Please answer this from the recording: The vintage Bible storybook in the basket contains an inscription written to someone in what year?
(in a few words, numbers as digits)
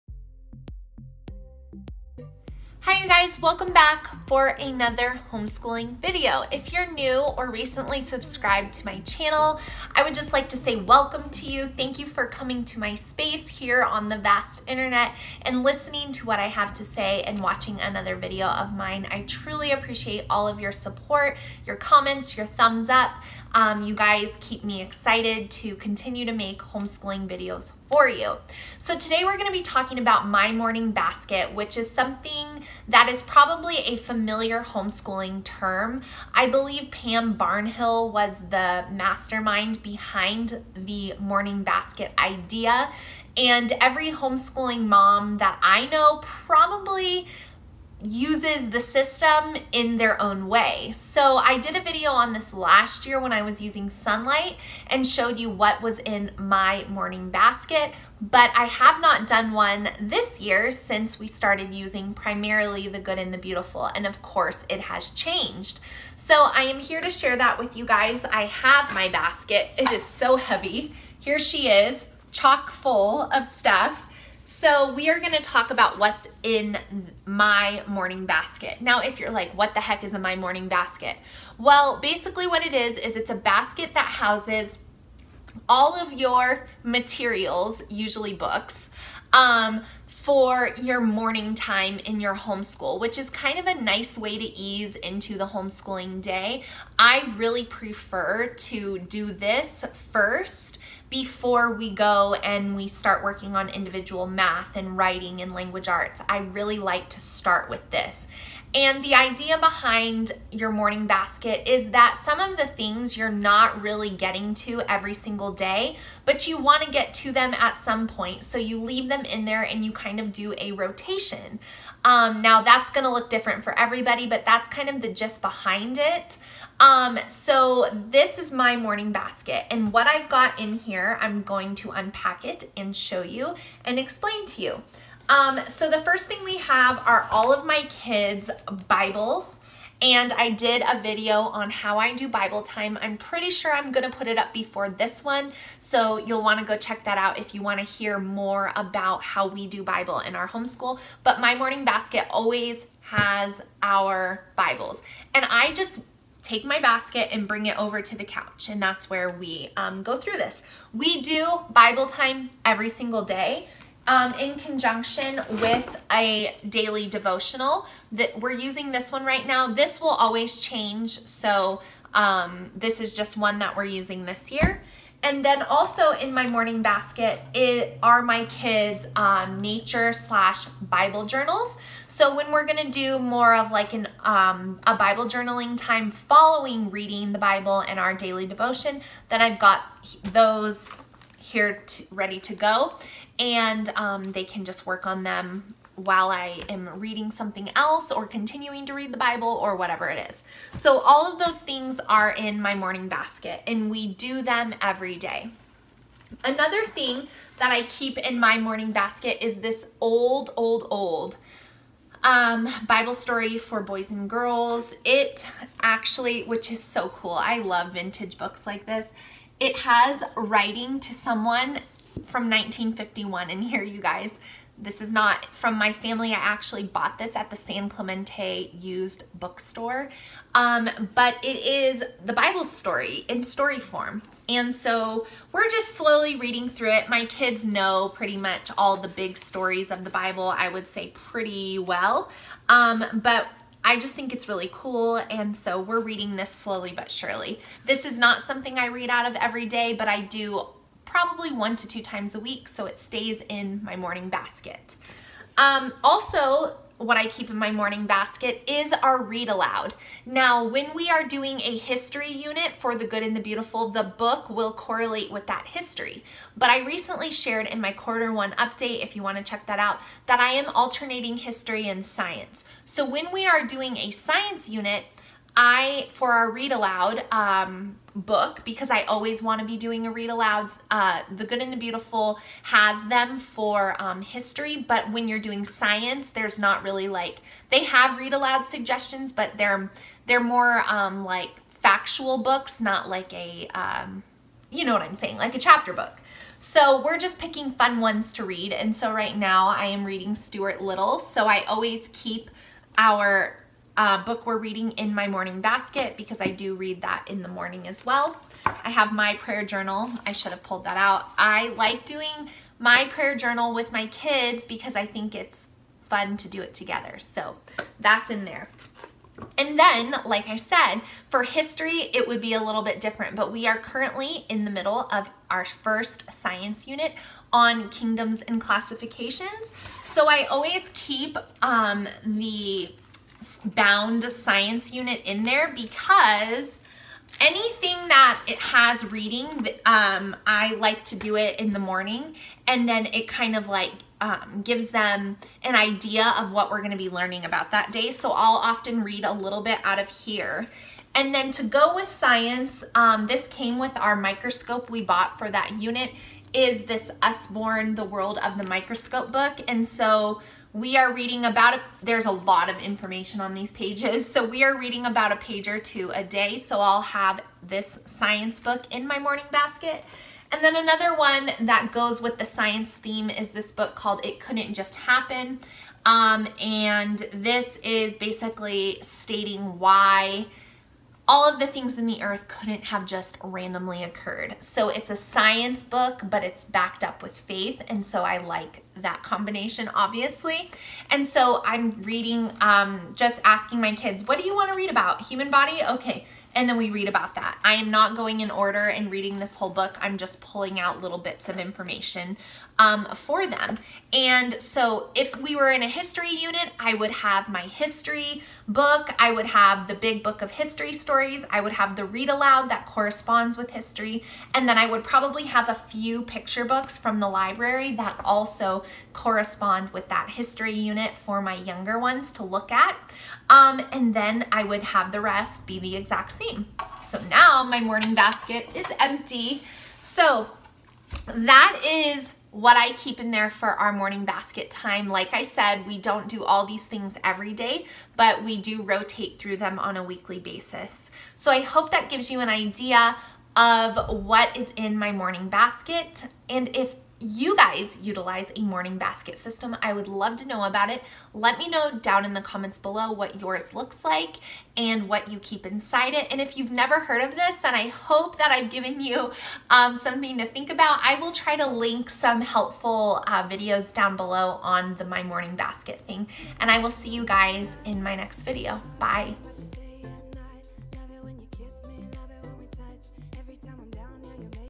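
1951.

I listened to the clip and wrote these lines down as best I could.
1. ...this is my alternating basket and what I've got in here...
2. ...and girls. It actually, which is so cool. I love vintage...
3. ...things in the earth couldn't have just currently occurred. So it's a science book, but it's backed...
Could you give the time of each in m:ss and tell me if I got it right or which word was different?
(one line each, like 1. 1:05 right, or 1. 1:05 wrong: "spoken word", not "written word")
1. 2:08 wrong: "morning", not "alternating"
2. 3:34 right
3. 6:21 wrong: "randomly", not "currently".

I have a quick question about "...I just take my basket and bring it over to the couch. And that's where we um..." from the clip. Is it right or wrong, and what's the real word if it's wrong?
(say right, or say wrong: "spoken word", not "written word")
right.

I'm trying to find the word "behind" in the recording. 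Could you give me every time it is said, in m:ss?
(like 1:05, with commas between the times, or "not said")
0:39, 1:49, 2:05.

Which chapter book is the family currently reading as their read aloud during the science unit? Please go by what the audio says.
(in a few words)
Stuart Little.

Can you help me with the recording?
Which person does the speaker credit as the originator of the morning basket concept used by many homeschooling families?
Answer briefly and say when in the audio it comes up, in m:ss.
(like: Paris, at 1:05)
Pam Barnhill, at 0:36.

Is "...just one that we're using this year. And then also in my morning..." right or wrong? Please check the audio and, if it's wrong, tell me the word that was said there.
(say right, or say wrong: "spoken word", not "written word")
right.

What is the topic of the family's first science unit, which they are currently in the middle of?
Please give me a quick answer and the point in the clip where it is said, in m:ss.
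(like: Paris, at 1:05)
Kingdoms and classifications, at 5:27.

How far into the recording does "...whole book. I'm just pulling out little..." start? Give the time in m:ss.
6:39.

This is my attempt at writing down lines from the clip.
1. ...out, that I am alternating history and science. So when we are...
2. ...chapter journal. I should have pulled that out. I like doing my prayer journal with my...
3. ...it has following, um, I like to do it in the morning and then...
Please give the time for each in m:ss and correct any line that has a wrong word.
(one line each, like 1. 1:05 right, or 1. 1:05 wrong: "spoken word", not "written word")
1. 4:29 right
2. 5:09 wrong: "prayer", not "chapter"
3. 5:38 wrong: "reading", not "following".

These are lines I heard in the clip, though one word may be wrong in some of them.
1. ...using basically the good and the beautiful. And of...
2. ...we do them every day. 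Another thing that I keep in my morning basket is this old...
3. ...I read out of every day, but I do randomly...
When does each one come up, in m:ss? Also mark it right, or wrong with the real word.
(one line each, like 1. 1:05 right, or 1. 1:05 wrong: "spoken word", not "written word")
1. 1:01 wrong: "primarily", not "basically"
2. 3:23 right
3. 4:08 wrong: "probably", not "randomly".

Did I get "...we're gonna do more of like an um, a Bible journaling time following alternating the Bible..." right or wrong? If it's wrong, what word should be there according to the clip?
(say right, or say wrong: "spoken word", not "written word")
wrong: "reading", not "alternating".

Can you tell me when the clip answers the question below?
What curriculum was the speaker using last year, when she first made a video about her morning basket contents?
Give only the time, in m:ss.
0:53.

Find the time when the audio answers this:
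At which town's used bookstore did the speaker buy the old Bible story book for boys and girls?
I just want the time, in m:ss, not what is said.
3:47.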